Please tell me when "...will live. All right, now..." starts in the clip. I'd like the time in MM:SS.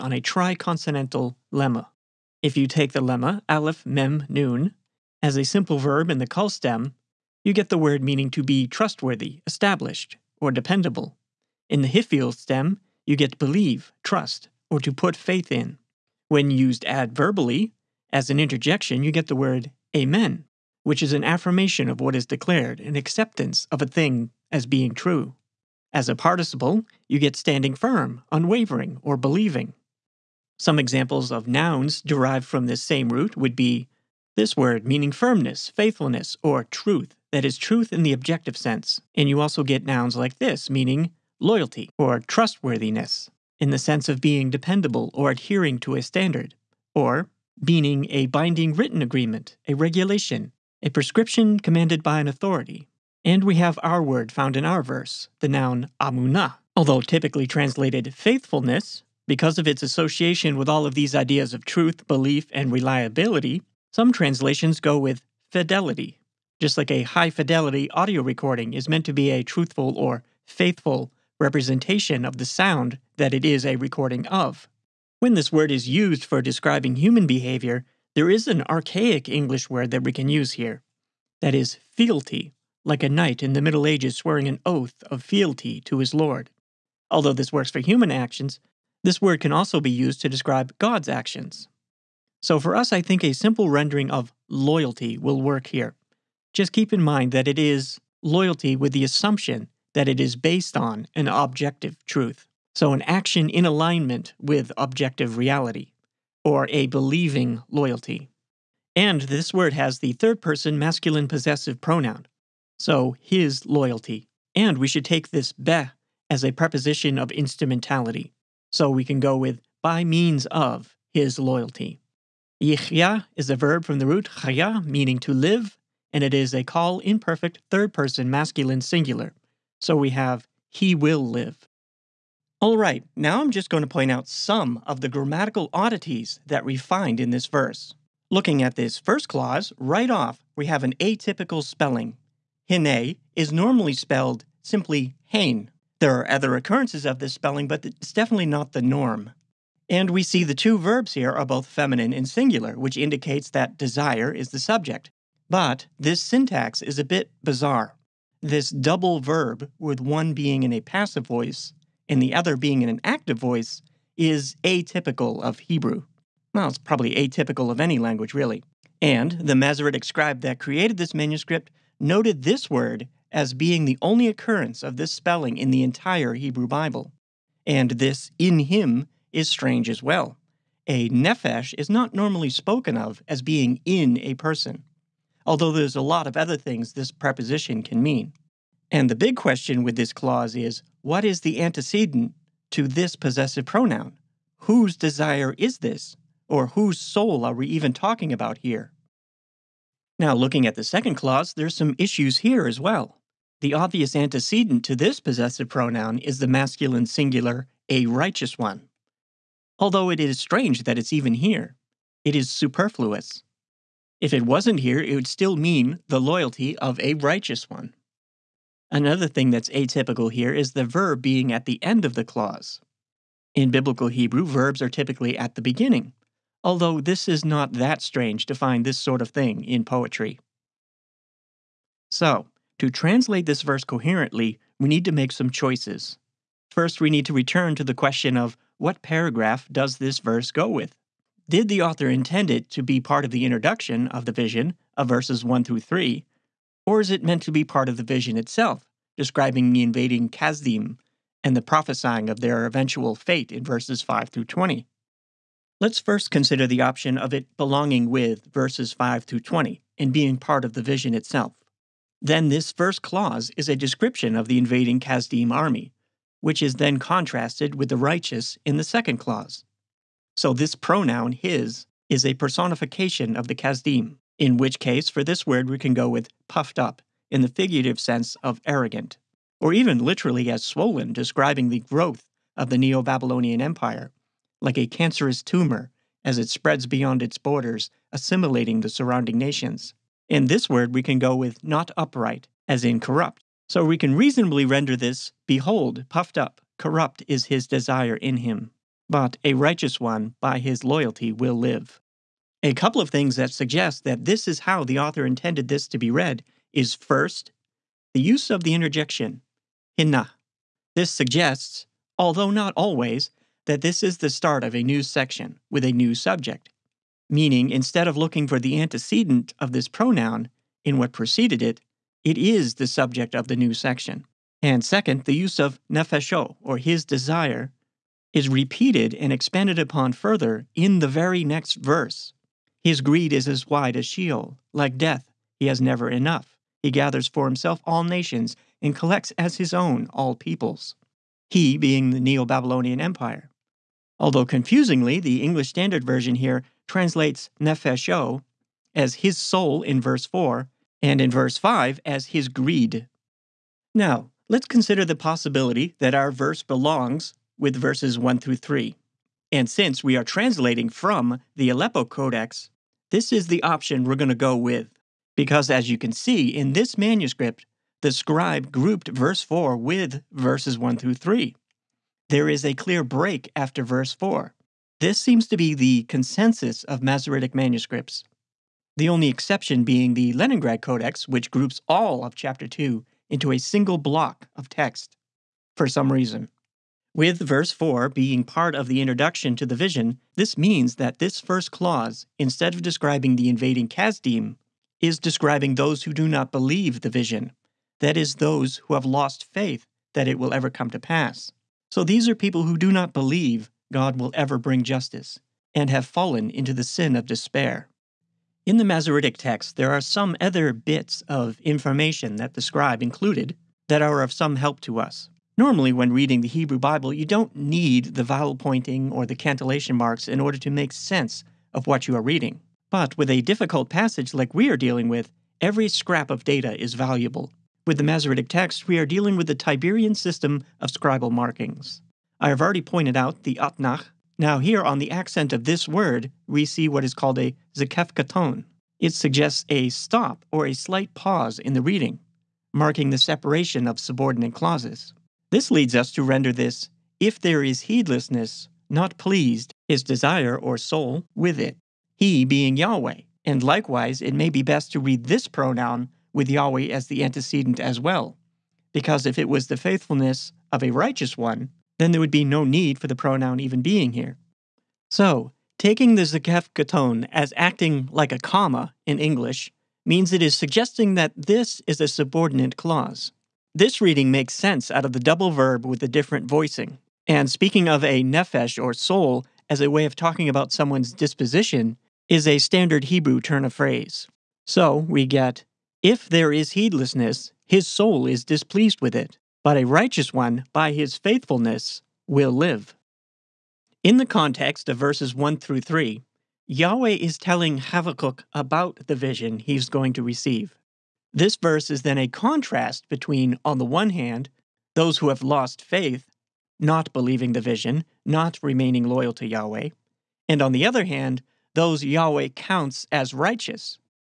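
02:10.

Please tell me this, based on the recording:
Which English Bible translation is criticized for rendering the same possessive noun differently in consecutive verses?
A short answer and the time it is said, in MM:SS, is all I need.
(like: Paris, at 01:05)
English Standard Version, at 05:45.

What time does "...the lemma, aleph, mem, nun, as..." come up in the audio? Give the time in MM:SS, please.
00:02.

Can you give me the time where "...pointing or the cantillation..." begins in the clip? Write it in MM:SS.
06:58.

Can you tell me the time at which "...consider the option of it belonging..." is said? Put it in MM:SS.
04:16.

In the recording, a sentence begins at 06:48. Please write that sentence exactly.
In the Masoretic text, there are some other bits of information that the scribe included that are of some help to us.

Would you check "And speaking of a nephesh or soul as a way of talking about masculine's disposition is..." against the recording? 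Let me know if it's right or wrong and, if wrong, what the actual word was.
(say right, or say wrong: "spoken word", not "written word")
wrong: "someone", not "masculine".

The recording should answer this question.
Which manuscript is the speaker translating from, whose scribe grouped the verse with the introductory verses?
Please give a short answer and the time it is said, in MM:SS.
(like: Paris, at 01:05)
Aleppo Codex, at 06:01.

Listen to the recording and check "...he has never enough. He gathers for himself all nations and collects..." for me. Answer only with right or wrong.
right.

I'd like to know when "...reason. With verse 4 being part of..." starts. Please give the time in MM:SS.
06:26.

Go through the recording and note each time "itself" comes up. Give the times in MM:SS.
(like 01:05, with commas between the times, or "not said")
04:08, 04:21.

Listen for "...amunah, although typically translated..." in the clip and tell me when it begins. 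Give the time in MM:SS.
00:55.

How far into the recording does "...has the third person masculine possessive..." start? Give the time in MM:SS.
01:49.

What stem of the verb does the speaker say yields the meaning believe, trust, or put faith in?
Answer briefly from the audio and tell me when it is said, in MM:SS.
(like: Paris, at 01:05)
Hifil, at 00:11.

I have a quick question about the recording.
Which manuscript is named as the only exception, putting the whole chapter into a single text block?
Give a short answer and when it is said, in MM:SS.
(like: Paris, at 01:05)
Leningrad Codex, at 06:20.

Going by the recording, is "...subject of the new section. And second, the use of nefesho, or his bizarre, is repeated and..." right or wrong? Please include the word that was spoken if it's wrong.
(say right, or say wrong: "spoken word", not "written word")
wrong: "desire", not "bizarre".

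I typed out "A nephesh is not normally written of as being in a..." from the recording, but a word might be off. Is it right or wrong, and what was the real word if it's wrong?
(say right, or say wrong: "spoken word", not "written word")
wrong: "spoken", not "written".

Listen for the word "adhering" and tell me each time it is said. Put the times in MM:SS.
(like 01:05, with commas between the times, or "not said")
00:45.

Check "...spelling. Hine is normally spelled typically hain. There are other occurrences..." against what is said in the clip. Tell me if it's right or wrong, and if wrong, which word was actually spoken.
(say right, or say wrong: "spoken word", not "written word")
wrong: "simply", not "typically".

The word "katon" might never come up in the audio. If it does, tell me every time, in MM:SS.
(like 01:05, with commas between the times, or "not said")
07:18, 07:46.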